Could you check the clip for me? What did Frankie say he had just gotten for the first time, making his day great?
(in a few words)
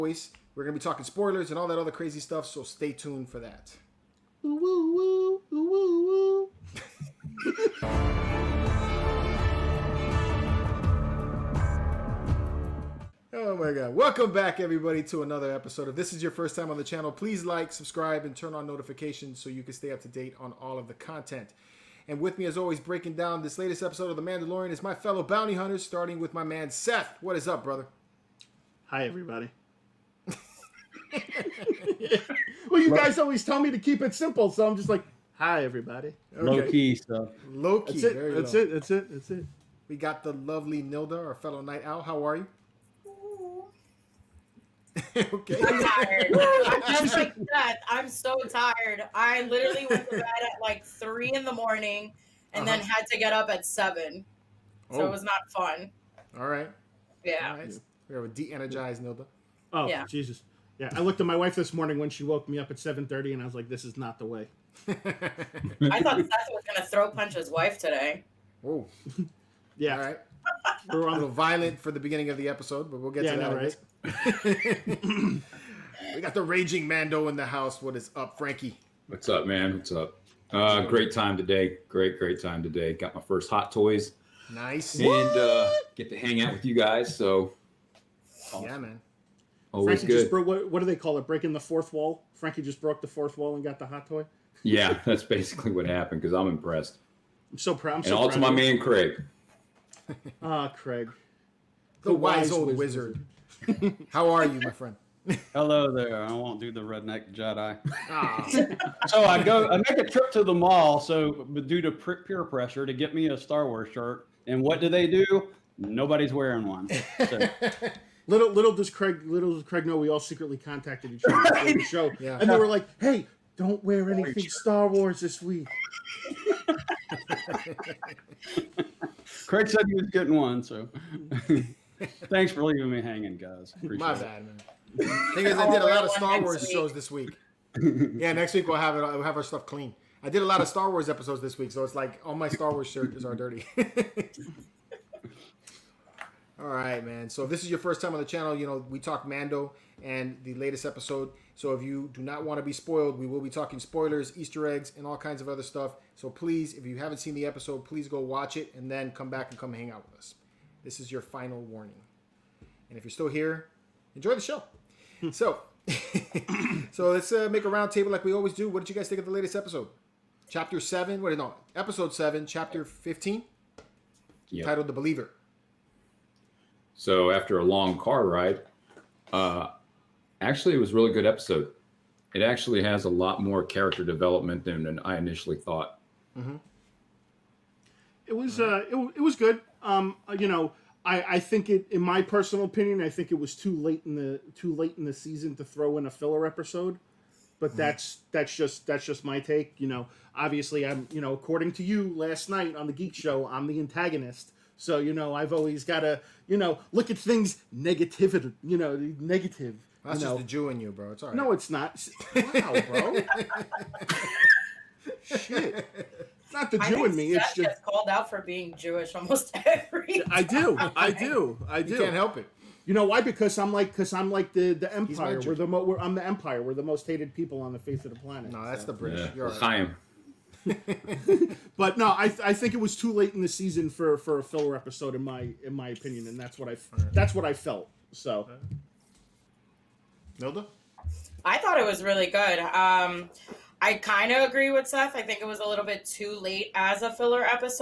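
Hot toys.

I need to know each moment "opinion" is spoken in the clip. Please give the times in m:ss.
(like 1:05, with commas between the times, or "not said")
3:12, 3:55.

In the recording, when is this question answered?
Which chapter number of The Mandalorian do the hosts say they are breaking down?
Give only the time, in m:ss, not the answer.
2:52.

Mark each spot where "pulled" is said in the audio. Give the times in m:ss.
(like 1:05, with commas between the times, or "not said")
not said.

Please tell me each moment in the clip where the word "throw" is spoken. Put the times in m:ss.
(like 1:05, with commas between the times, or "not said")
1:06, 3:15.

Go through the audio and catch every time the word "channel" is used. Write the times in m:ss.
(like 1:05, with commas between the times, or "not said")
0:16, 2:28.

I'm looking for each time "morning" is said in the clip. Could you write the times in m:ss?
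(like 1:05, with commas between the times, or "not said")
0:51, 1:01.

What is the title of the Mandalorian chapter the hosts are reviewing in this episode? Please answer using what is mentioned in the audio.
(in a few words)
The Believer.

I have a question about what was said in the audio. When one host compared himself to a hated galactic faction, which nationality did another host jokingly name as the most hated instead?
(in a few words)
British.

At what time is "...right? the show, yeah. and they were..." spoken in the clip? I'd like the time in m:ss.
2:01.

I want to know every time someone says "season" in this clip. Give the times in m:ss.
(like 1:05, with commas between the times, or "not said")
3:15, 3:53.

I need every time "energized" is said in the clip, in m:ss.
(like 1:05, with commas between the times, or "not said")
0:58.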